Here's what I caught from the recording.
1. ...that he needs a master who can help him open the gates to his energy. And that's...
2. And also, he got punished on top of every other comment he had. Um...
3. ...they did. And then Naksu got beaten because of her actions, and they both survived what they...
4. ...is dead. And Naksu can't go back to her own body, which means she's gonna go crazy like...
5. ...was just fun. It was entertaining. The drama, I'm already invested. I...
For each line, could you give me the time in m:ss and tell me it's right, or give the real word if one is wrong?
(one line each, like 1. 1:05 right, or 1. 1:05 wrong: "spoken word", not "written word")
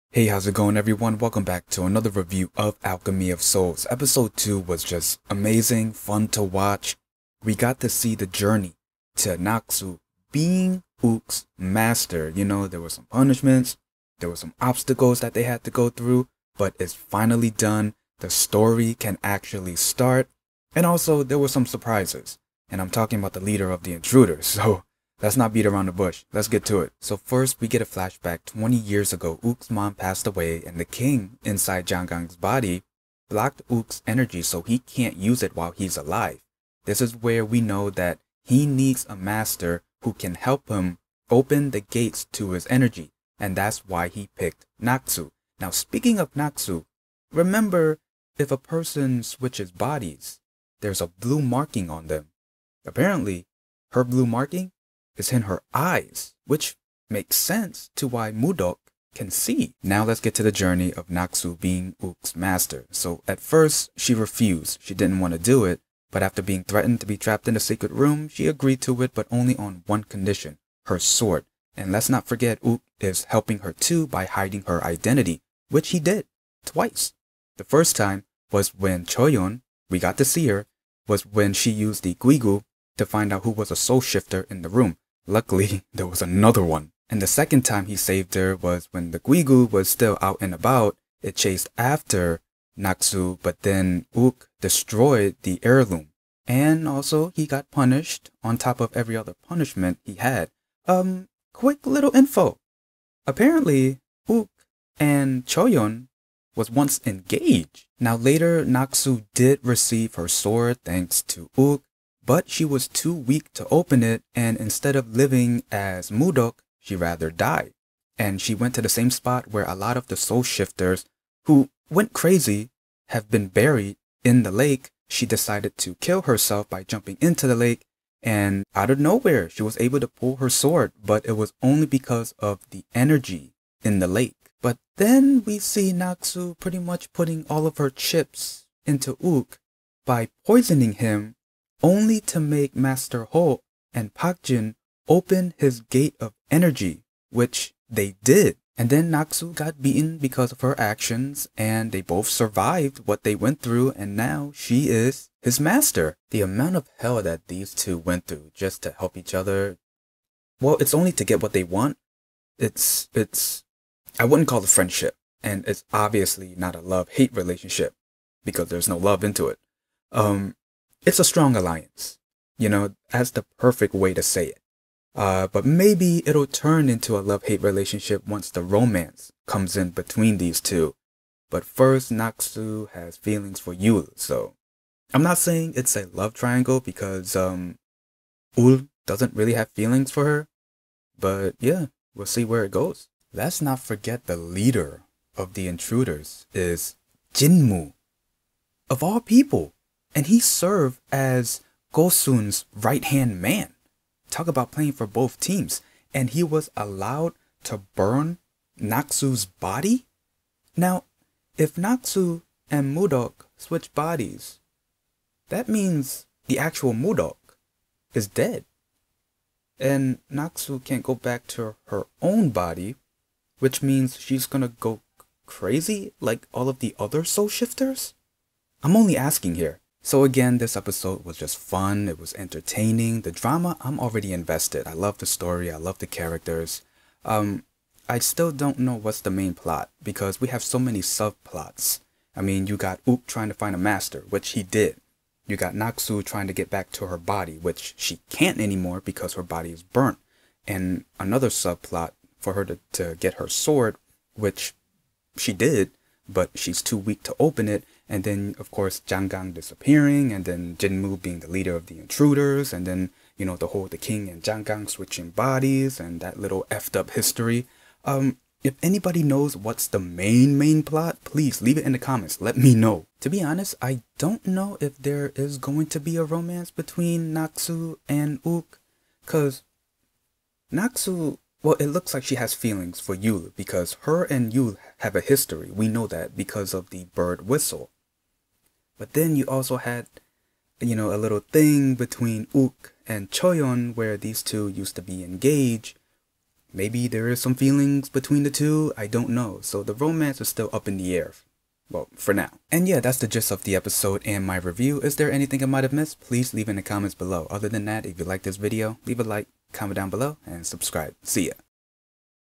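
1. 0:37 right
2. 1:36 wrong: "punishment", not "comment"
3. 2:27 right
4. 3:38 right
5. 3:51 right.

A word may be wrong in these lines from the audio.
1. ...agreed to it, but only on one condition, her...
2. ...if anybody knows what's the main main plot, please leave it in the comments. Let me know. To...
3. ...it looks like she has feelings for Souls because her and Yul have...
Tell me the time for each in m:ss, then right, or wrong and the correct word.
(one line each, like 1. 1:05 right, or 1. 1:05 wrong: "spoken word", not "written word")
1. 1:08 right
2. 4:28 right
3. 4:41 wrong: "Yul", not "Souls".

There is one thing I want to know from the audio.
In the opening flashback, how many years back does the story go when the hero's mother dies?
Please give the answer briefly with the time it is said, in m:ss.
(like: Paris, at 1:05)
20, at 0:28.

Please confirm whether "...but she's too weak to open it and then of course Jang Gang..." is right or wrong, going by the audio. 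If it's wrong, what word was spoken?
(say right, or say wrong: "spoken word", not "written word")
right.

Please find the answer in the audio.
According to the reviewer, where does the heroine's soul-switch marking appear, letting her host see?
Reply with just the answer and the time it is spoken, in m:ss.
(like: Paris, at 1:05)
Her eyes, at 0:55.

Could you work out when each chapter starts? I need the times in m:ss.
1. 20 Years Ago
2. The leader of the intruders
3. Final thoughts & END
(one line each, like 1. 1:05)
1. 0:26
2. 3:13
3. 3:49.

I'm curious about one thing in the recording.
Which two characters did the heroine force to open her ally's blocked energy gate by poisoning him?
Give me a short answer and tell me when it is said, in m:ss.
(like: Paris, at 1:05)
Master Ho and Park Jin, at 2:22.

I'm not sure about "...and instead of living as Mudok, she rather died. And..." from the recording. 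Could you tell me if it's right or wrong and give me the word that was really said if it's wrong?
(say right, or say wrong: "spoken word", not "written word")
right.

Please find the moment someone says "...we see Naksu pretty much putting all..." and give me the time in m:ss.
2:15.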